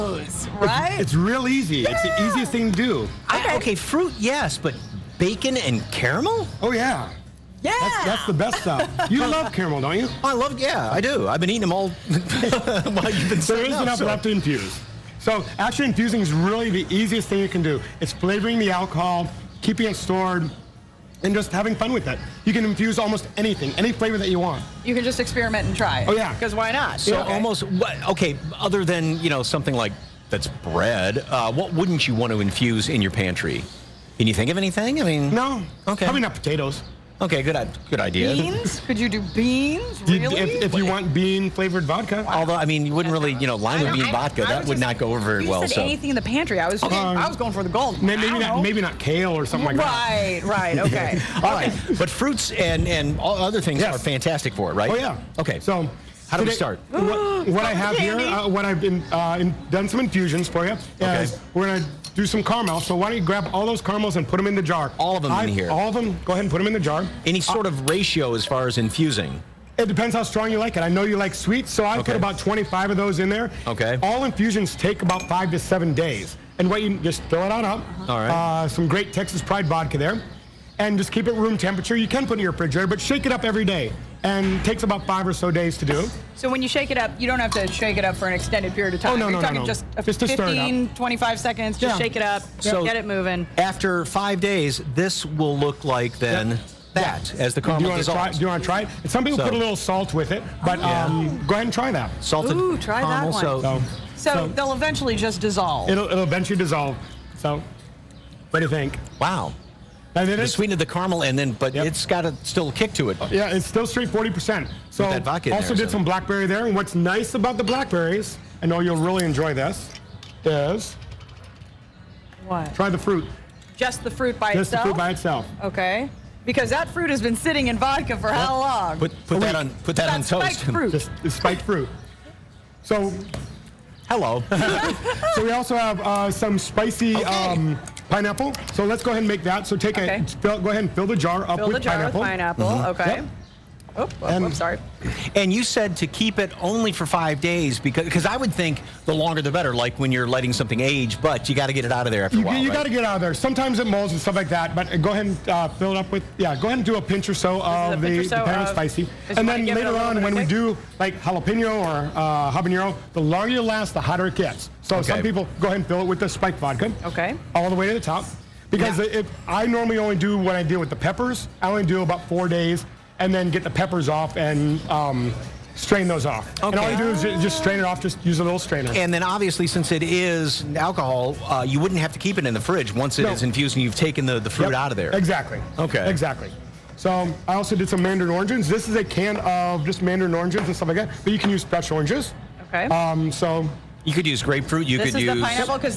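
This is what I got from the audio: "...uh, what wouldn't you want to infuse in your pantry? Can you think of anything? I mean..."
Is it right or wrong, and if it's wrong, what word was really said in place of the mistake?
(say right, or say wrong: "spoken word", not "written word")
right.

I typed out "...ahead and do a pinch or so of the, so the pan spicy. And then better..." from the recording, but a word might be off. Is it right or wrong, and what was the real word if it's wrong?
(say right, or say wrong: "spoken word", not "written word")
wrong: "later", not "better".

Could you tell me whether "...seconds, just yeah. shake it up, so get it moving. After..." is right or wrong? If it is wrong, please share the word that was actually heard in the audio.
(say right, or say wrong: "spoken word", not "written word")
right.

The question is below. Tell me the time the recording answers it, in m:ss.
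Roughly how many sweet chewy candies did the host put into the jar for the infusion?
1:12.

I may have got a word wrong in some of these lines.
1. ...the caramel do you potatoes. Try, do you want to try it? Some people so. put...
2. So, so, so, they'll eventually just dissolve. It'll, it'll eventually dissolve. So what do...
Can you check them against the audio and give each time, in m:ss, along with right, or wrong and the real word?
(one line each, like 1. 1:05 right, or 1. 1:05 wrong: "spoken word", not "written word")
1. 1:37 wrong: "dissolves", not "potatoes"
2. 1:43 right.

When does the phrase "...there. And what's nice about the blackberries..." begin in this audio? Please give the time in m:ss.
1:56.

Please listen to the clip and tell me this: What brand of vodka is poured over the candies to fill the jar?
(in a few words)
Texas Pride.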